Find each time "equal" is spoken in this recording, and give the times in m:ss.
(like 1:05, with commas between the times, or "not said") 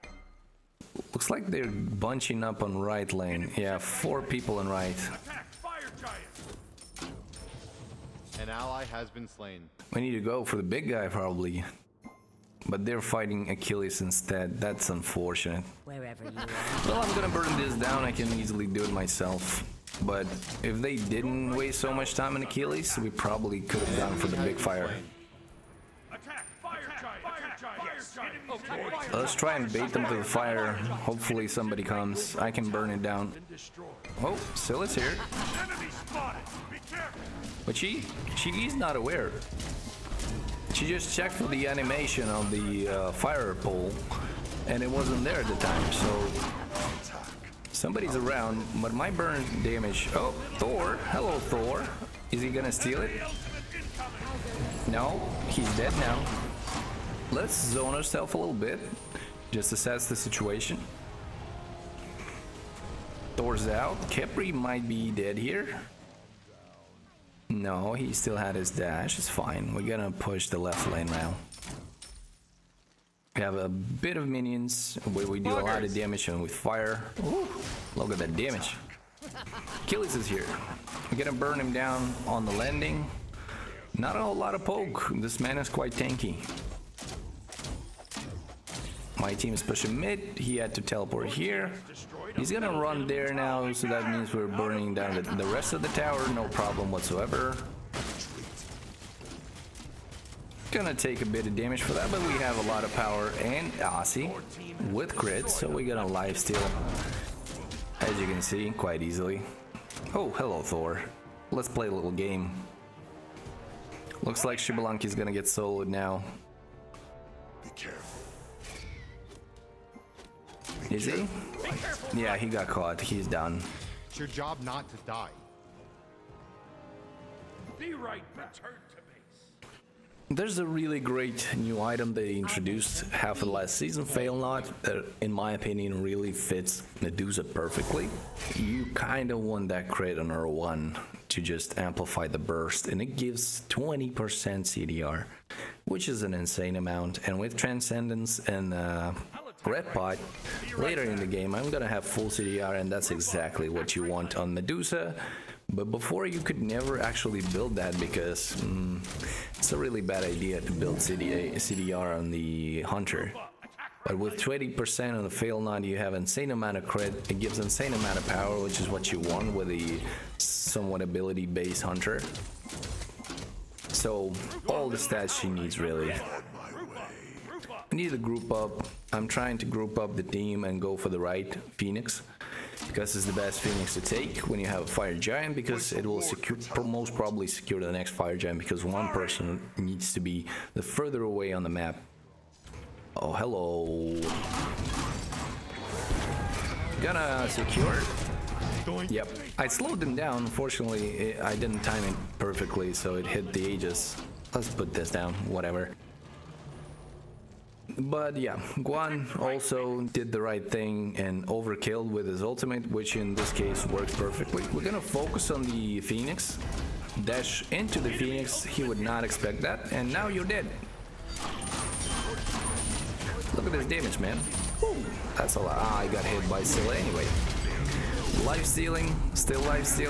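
not said.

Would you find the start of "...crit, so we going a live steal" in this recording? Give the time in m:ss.
1:45.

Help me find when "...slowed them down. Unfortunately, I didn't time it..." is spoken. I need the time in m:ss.
3:19.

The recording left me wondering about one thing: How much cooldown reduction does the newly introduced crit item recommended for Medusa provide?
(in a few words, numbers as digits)
20%.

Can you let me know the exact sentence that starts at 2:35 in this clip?
But before you could never actually build that because mm, it's a really bad idea to build CD CDR on the Hunter.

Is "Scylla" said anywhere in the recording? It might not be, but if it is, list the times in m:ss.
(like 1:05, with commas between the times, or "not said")
0:34, 3:46.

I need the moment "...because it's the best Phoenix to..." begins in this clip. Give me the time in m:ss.
3:02.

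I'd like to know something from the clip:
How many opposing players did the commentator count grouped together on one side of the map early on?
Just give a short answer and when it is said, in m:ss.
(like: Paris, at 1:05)
4, at 0:03.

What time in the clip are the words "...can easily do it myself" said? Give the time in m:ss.
0:18.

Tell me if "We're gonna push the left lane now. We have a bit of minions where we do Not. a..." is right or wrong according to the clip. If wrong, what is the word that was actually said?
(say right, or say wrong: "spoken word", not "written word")
wrong: "Buggers", not "Not".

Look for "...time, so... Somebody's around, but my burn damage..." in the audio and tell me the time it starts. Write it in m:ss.
0:45.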